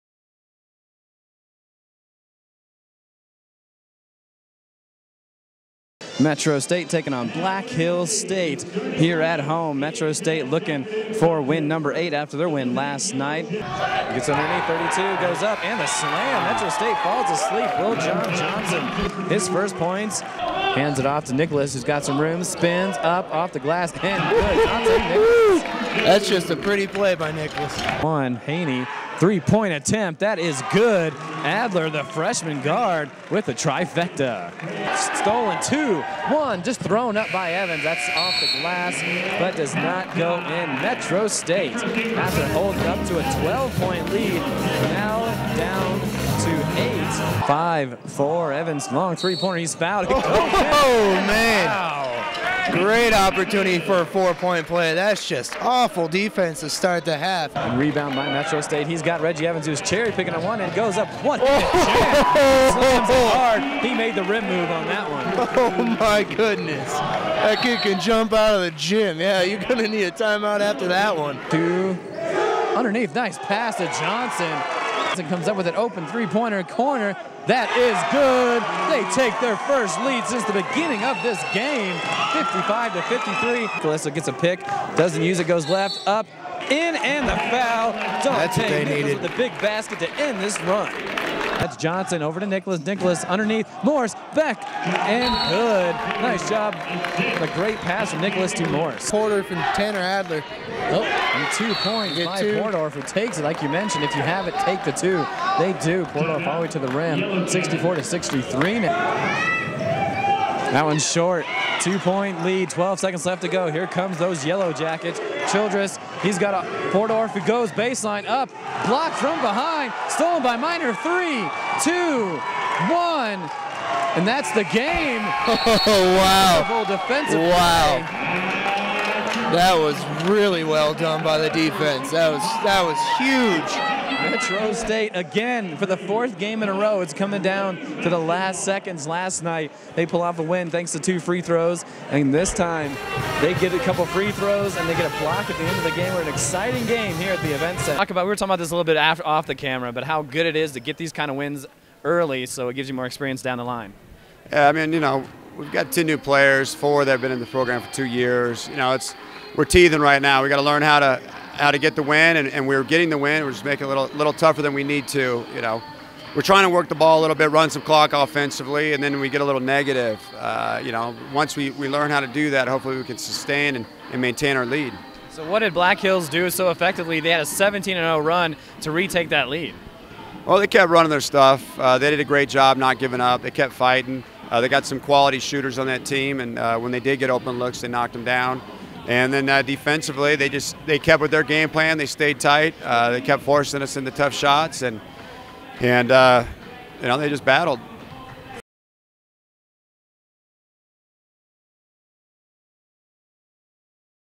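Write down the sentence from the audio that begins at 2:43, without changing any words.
We're just making it a little, little tougher than we need to, you know.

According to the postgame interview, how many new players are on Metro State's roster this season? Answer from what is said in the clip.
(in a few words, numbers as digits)
10.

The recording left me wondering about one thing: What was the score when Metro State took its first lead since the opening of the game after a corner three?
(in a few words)
55 to 53.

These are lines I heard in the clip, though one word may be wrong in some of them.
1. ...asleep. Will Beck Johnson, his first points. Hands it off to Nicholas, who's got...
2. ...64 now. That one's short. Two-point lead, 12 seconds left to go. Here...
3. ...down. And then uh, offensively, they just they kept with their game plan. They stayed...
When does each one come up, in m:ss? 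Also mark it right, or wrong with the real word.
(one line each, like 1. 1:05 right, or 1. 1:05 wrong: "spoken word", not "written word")
1. 0:17 wrong: "John", not "Beck"
2. 1:48 wrong: "63", not "64"
3. 3:08 wrong: "defensively", not "offensively".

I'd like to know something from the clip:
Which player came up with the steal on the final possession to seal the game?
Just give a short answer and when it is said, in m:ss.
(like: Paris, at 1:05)
Miner, at 2:00.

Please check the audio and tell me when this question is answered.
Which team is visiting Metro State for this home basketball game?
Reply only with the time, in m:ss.
0:07.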